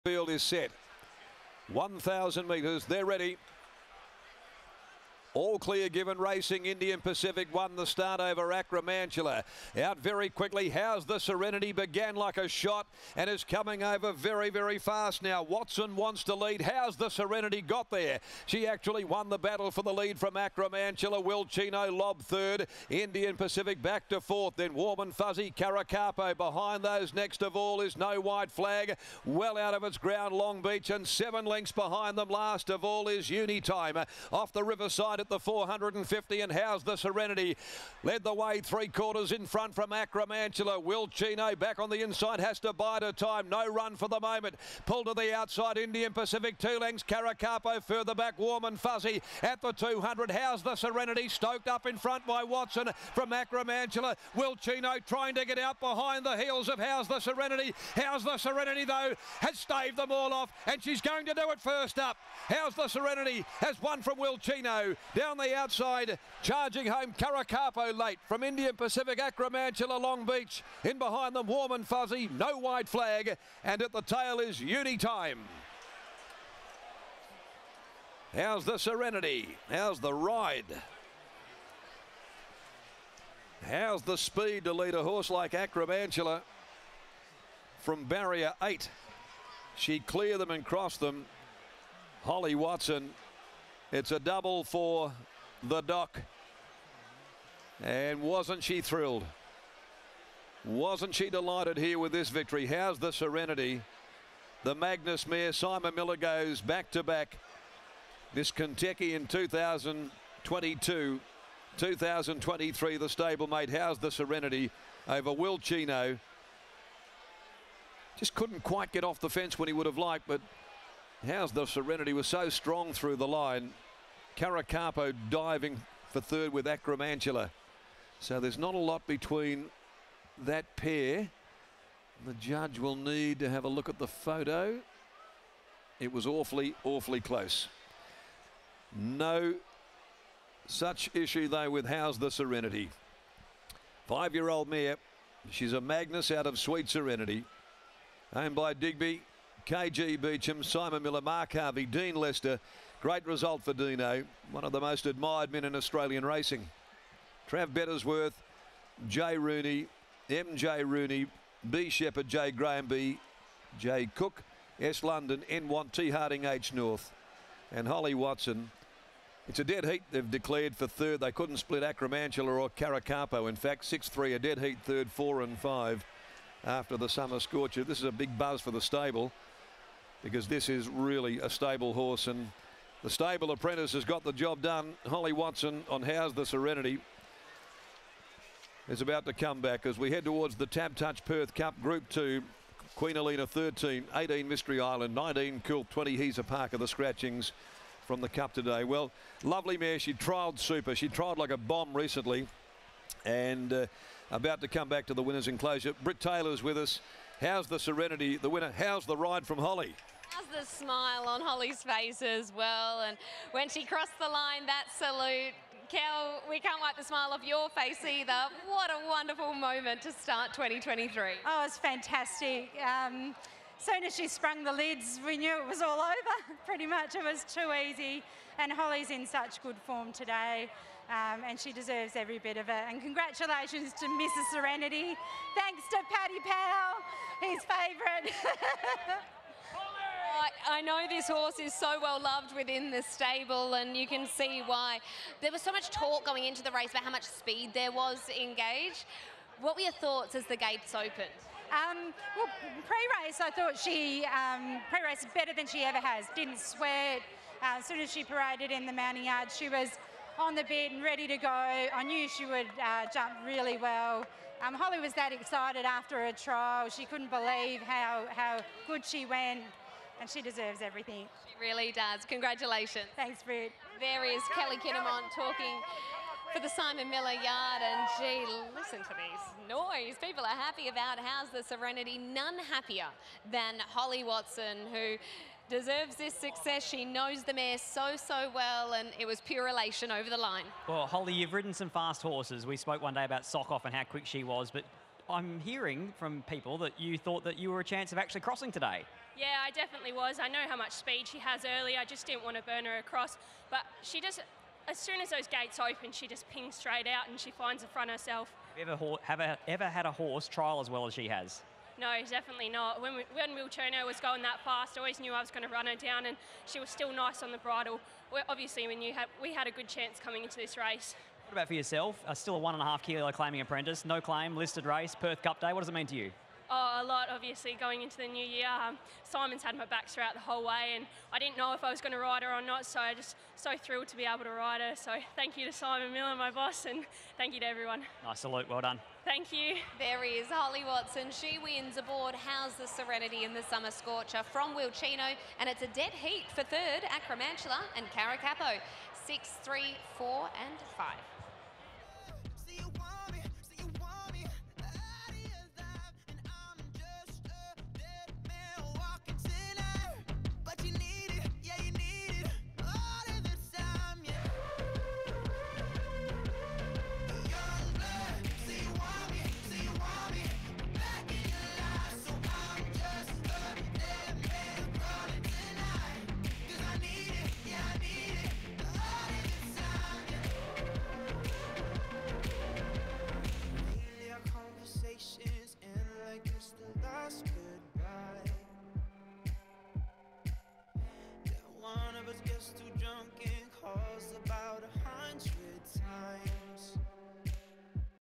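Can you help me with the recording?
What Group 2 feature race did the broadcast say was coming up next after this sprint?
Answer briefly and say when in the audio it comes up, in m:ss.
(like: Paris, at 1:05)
TABtouch Perth Cup, at 3:10.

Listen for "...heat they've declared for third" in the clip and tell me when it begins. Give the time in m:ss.
2:49.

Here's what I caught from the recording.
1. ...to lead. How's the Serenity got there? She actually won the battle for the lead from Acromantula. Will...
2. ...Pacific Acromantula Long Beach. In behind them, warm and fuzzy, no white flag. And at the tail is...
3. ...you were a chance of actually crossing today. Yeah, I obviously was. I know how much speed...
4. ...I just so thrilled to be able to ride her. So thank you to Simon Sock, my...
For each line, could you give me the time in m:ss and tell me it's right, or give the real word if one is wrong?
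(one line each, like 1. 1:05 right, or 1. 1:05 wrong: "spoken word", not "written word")
1. 0:16 right
2. 1:08 right
3. 4:57 wrong: "definitely", not "obviously"
4. 5:33 wrong: "Miller", not "Sock".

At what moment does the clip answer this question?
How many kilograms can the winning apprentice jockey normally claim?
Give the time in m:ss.
5:22.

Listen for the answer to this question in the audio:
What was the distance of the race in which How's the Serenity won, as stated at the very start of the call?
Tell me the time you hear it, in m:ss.
0:01.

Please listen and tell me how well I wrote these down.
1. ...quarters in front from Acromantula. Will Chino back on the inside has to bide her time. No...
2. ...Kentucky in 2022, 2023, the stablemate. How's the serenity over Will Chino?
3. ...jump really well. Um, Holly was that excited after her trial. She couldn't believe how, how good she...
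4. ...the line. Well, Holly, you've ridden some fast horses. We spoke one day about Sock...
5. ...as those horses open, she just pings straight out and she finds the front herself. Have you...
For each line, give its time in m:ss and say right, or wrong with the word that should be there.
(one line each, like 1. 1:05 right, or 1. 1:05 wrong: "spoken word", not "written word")
1. 0:38 right
2. 1:48 right
3. 4:23 right
4. 4:50 right
5. 5:05 wrong: "gates", not "horses".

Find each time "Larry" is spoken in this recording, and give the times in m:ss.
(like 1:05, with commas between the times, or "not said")
not said.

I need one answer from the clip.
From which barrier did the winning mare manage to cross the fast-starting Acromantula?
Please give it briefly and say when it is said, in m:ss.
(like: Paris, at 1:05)
8, at 1:28.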